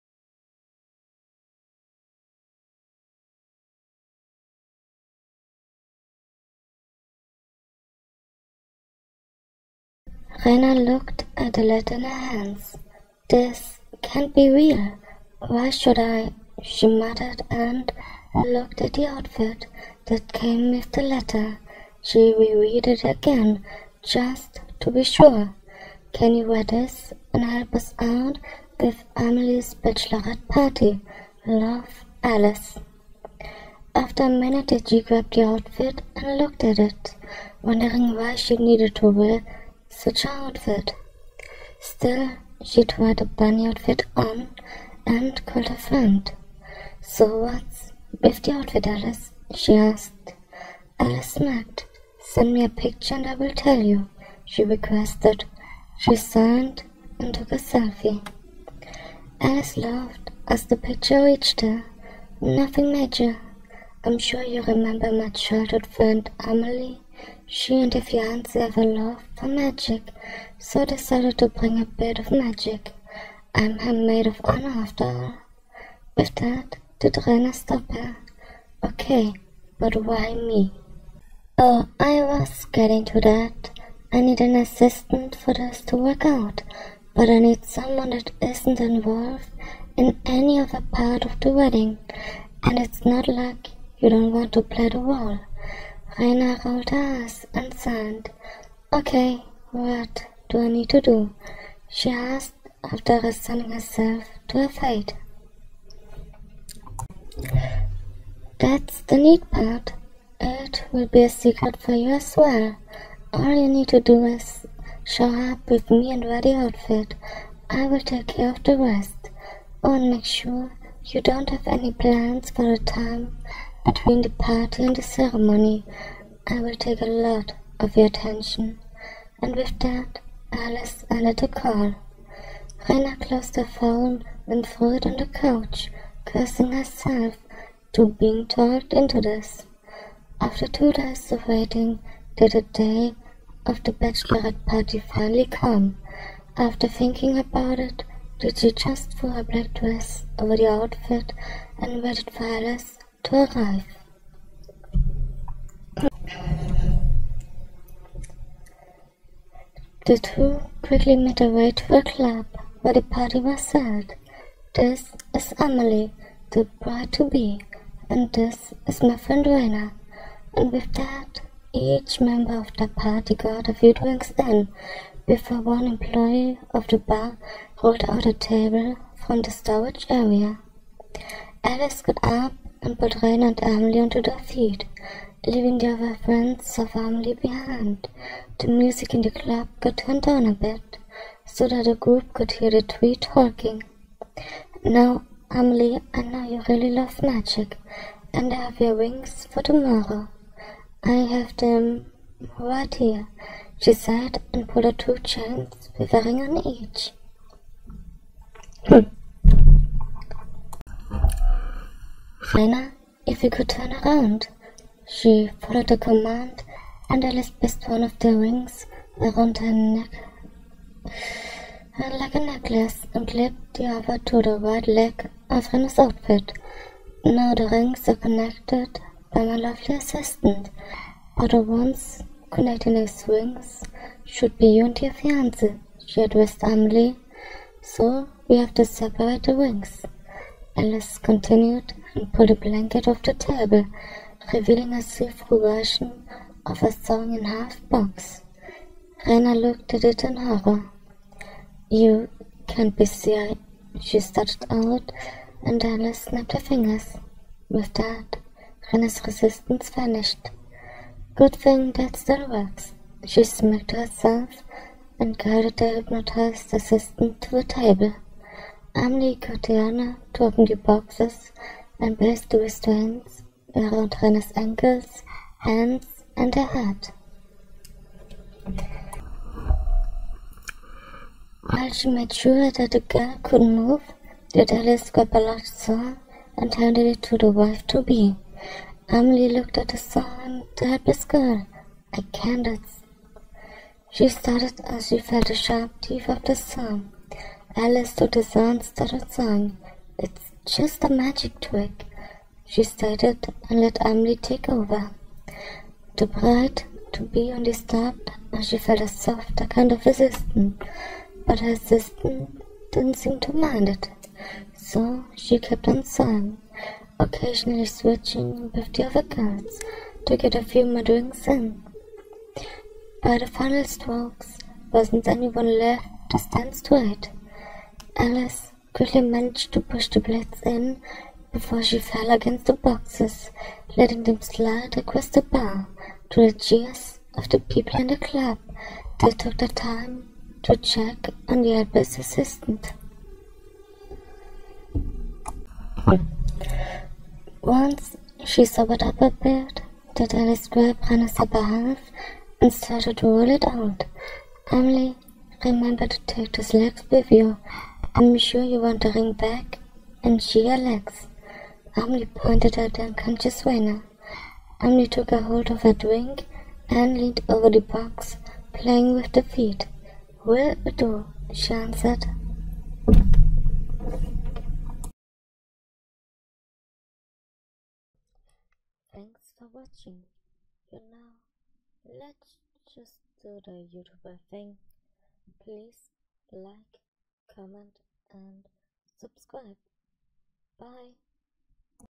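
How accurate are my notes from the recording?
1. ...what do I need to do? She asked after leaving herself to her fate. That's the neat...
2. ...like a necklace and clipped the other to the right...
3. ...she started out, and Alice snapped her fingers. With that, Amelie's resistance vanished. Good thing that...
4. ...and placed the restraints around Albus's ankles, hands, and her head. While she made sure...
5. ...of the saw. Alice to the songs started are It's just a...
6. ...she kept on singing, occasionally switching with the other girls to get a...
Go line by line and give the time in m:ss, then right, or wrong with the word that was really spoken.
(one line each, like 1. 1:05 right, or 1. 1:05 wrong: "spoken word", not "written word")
1. 1:39 wrong: "resigning", not "leaving"
2. 3:42 right
3. 4:13 wrong: "Rena", not "Amelie"
4. 4:31 wrong: "Hannah", not "Albus"
5. 4:56 right
6. 5:15 right.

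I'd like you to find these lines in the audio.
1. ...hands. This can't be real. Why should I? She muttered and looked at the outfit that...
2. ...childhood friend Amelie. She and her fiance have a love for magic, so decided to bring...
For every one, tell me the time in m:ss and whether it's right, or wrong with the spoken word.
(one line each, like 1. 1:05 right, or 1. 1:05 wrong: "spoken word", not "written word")
1. 0:12 right
2. 1:05 right.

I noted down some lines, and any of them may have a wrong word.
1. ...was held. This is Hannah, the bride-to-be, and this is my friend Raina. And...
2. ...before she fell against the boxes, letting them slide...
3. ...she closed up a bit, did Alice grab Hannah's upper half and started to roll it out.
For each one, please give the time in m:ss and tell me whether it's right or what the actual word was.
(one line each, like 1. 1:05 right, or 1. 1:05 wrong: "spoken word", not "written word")
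1. 2:43 wrong: "Emily", not "Hannah"
2. 5:31 right
3. 5:48 wrong: "sobered", not "closed".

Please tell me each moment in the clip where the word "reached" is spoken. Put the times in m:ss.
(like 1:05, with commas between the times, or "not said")
1:01.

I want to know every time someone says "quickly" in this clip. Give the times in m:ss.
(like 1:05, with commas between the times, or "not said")
2:40, 5:28.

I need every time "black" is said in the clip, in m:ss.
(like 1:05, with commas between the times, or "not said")
2:29.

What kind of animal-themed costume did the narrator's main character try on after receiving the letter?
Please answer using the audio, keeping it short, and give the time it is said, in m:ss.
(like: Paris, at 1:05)
Bunny outfit, at 0:43.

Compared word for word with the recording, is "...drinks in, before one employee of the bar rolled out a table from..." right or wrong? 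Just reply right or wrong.
right.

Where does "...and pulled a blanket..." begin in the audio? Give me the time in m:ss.
4:02.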